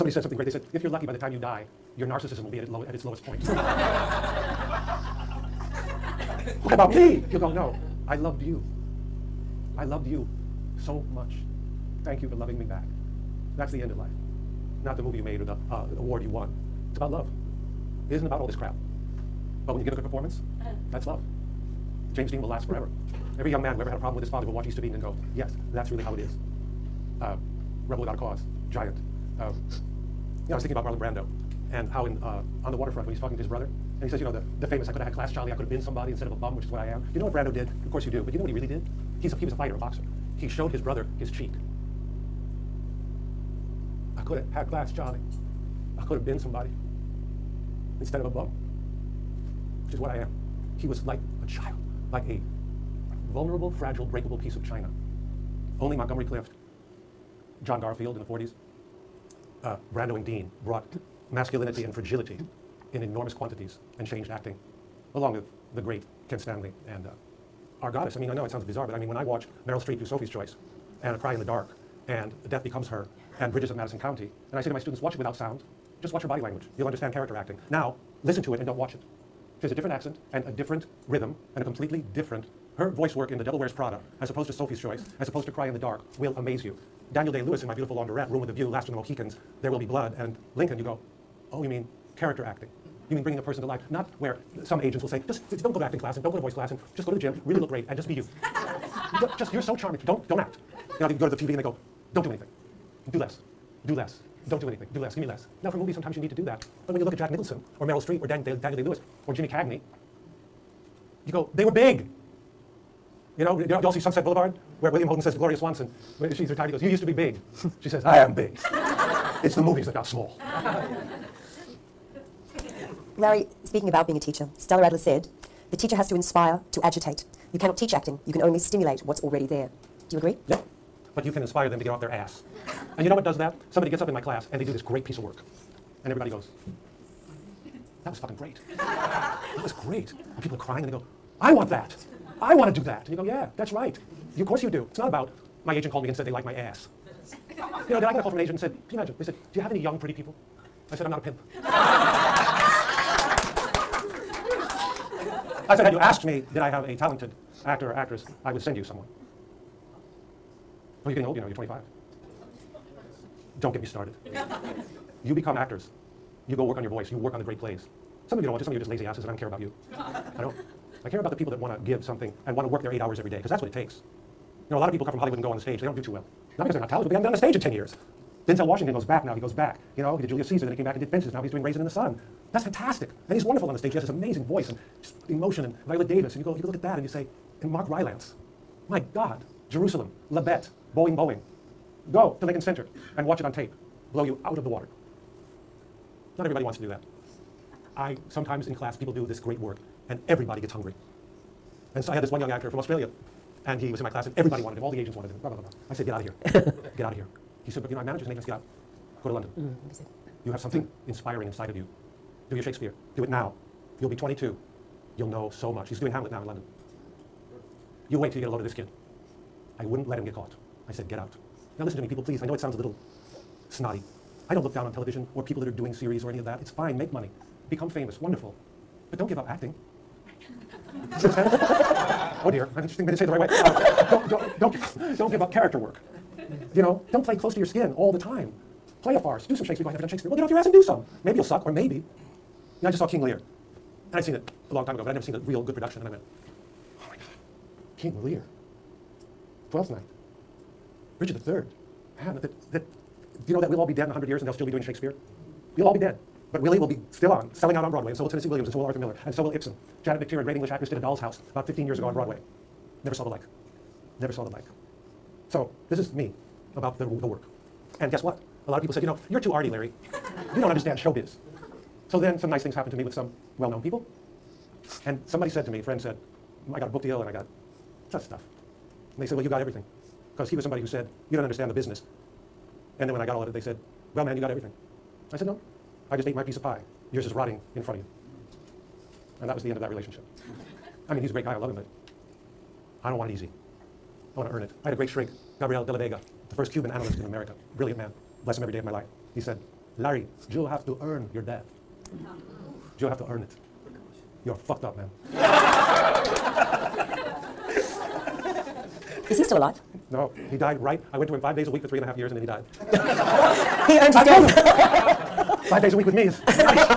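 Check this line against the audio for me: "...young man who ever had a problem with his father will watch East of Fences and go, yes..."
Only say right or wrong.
wrong.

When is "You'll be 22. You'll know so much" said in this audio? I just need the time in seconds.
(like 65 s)
214 s.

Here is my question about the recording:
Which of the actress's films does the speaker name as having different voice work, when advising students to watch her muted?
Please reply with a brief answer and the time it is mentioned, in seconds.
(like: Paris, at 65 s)
The Devil Wears Prada, at 83 s.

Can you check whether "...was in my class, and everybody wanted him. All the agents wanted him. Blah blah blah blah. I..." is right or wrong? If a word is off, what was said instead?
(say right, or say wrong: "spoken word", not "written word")
right.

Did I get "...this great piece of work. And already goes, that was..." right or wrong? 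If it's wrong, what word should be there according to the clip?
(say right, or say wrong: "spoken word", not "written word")
wrong: "everybody", not "already".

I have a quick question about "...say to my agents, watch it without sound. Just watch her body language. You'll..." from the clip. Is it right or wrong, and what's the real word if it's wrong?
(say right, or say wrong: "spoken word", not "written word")
wrong: "students", not "agents".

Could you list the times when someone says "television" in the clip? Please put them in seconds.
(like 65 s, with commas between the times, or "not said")
224 s.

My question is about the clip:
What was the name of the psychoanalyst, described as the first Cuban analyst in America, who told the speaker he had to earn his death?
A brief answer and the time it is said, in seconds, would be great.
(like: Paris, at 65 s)
Gabriel de la Vega, at 295 s.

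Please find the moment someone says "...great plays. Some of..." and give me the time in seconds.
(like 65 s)
167 s.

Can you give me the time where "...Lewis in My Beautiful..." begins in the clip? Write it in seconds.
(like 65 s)
87 s.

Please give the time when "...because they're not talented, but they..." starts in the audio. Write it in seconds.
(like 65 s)
176 s.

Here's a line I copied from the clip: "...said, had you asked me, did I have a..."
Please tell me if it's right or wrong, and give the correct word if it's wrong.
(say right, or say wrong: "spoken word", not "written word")
right.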